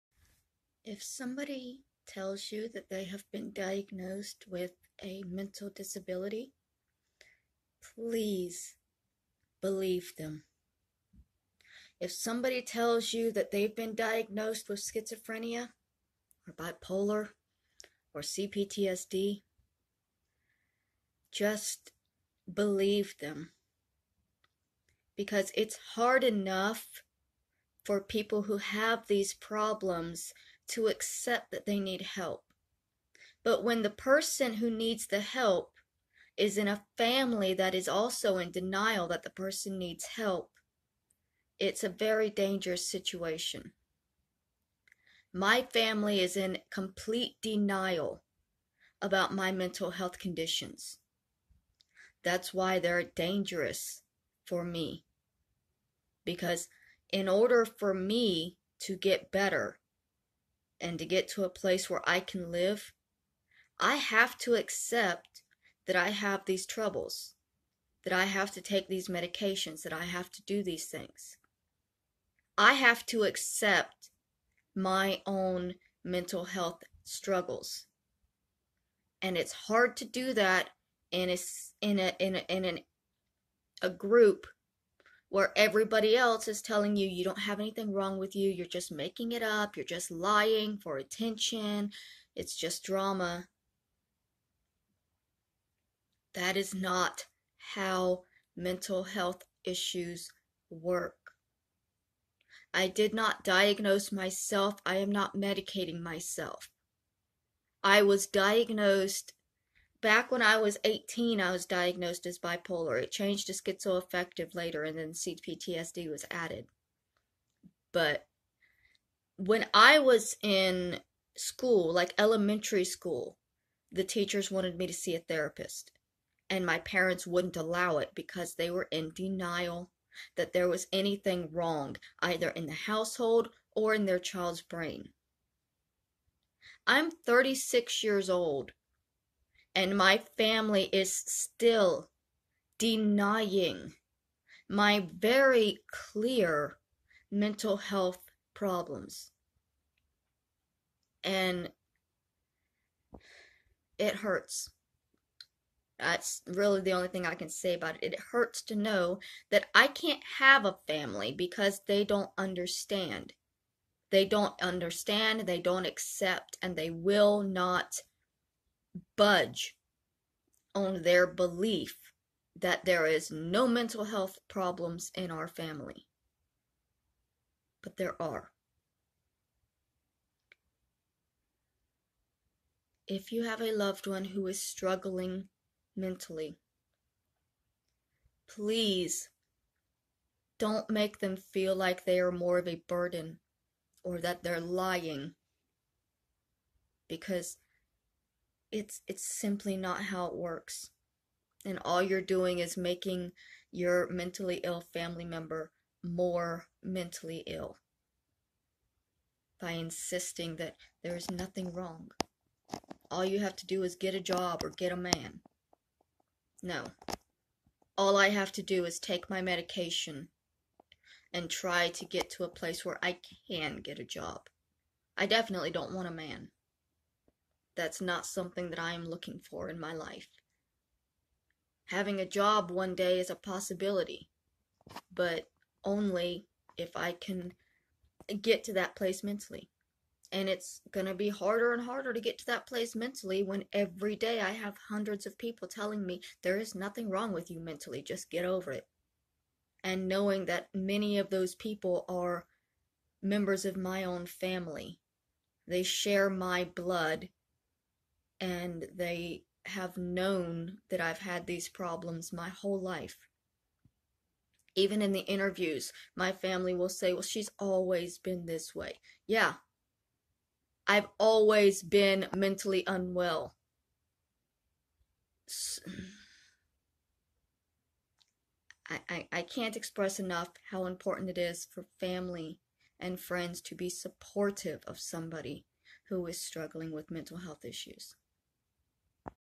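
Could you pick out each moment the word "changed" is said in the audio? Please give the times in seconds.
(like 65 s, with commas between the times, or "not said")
113 s.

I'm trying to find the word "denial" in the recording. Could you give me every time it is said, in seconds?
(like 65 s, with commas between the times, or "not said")
38 s, 47 s, 129 s.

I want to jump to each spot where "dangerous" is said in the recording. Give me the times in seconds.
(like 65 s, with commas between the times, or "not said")
42 s, 53 s.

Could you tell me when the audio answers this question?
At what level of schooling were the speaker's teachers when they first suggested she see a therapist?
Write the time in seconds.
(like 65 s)
122 s.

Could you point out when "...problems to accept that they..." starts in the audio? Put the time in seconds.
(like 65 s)
29 s.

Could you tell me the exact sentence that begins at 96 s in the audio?
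That is not how mental health issues work.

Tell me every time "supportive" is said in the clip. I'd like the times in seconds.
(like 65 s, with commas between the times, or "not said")
283 s.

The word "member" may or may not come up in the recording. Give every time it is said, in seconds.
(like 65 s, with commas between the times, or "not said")
205 s, 253 s.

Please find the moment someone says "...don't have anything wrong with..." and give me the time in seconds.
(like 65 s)
87 s.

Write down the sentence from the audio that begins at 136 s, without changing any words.
I'm 36 years old and my family is still denying my very clear mental health problems.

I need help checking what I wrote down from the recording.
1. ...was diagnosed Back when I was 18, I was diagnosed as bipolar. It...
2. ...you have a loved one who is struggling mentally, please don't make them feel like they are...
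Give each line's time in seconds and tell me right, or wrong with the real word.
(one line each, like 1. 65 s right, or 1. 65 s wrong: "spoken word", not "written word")
1. 108 s right
2. 183 s right.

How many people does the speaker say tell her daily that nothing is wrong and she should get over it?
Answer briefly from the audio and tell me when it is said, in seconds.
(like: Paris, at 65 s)
hundreds, at 244 s.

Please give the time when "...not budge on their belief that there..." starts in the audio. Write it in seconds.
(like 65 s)
167 s.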